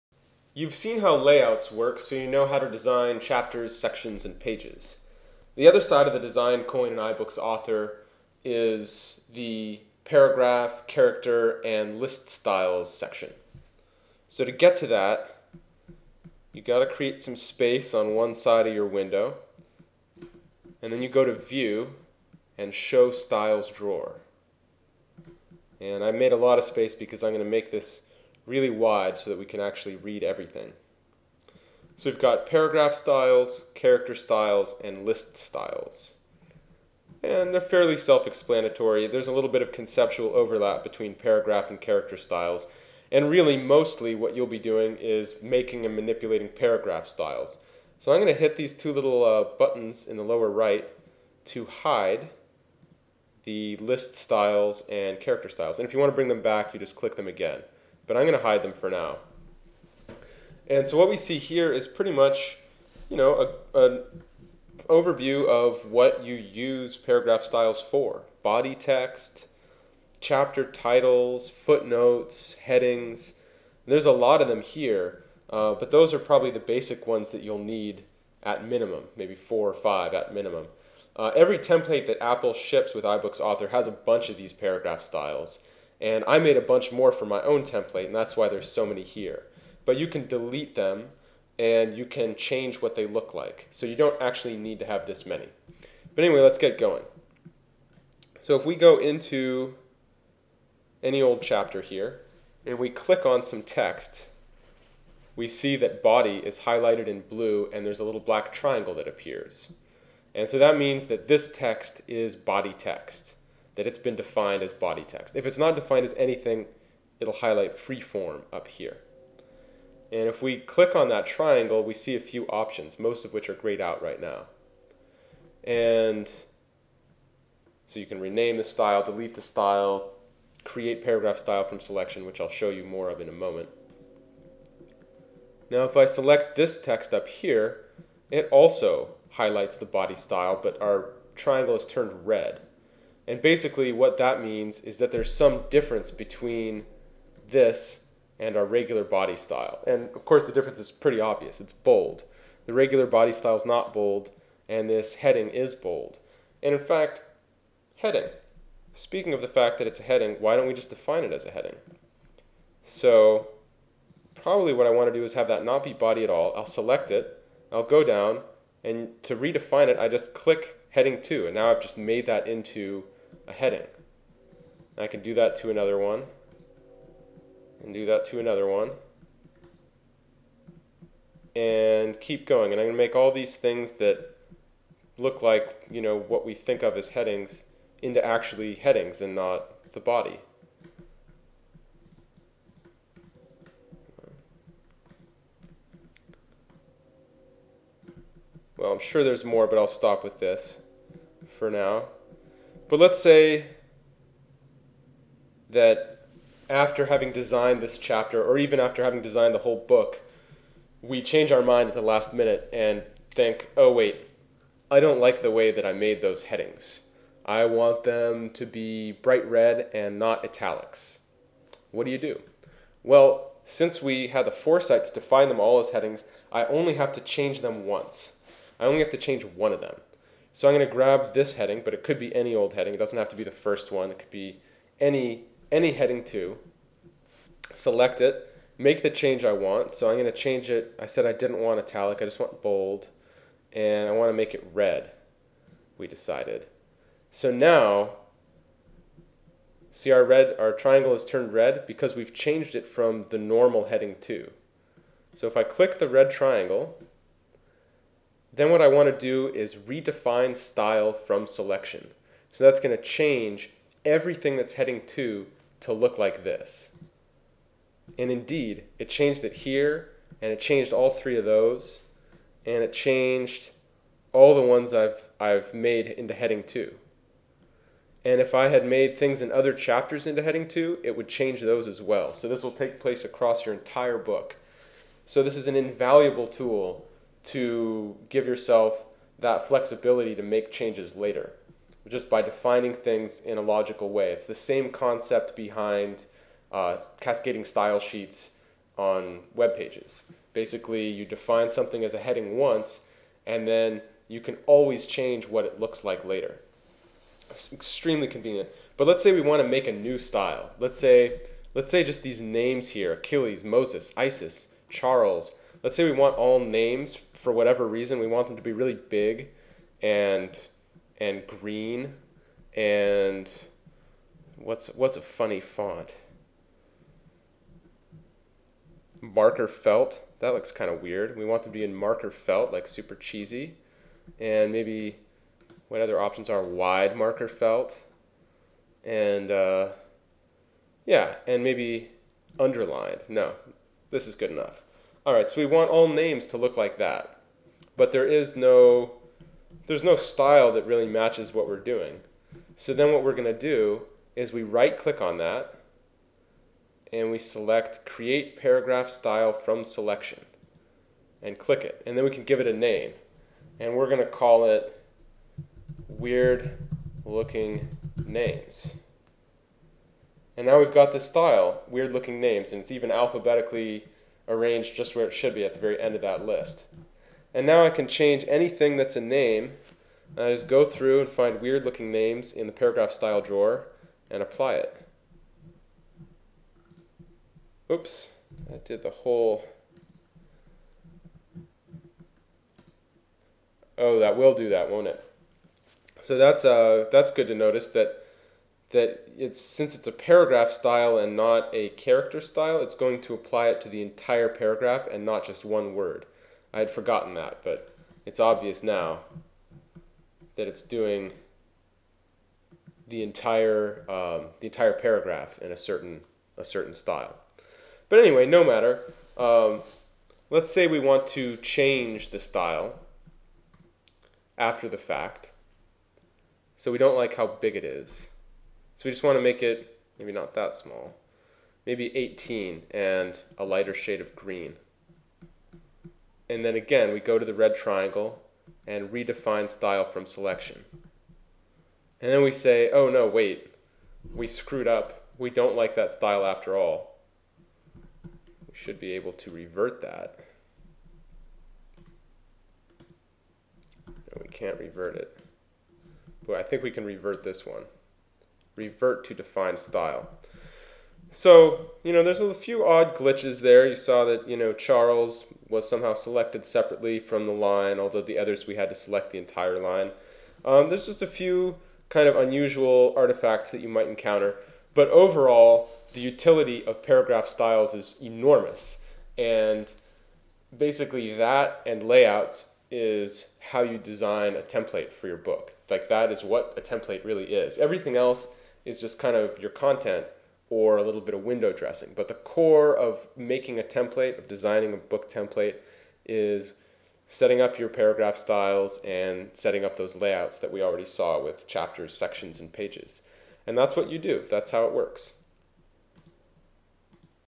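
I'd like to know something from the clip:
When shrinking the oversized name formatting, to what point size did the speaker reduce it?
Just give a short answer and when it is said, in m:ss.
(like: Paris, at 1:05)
18, at 7:12.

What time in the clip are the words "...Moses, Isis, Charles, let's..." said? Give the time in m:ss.
5:13.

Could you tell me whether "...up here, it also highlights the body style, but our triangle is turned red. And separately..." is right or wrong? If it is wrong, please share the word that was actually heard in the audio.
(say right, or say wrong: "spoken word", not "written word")
wrong: "basically", not "separately".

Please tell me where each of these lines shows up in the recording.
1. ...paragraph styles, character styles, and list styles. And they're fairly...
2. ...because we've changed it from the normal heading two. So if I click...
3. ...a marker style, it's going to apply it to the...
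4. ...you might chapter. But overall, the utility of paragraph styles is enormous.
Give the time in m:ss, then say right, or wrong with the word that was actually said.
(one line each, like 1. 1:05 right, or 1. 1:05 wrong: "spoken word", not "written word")
1. 0:32 right
2. 4:11 right
3. 6:41 wrong: "character", not "marker"
4. 7:53 wrong: "encounter", not "chapter".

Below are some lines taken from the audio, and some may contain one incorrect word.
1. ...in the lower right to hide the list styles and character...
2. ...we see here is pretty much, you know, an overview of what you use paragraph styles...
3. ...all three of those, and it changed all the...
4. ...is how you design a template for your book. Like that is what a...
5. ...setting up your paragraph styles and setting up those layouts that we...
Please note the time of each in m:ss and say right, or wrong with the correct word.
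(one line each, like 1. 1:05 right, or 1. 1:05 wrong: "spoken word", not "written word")
1. 0:50 right
2. 1:01 right
3. 4:30 right
4. 8:02 right
5. 8:17 right.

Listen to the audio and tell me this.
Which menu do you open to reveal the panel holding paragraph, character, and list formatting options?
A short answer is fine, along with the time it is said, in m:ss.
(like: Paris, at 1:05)
View, at 0:21.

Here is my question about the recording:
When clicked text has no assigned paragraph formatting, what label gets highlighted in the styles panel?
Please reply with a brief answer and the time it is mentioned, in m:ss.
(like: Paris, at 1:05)
Free form, at 1:57.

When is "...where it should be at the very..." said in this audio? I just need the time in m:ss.
6:15.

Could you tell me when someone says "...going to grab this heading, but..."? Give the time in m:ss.
3:50.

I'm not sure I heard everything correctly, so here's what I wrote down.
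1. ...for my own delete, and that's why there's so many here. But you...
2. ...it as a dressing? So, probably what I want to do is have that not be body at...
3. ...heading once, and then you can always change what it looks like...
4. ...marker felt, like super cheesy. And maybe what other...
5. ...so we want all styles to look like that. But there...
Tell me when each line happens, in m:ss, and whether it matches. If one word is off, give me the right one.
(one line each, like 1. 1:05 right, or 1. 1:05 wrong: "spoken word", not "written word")
1. 1:27 wrong: "template", not "delete"
2. 2:41 wrong: "heading", not "dressing"
3. 5:02 right
4. 5:31 right
5. 5:45 wrong: "names", not "styles".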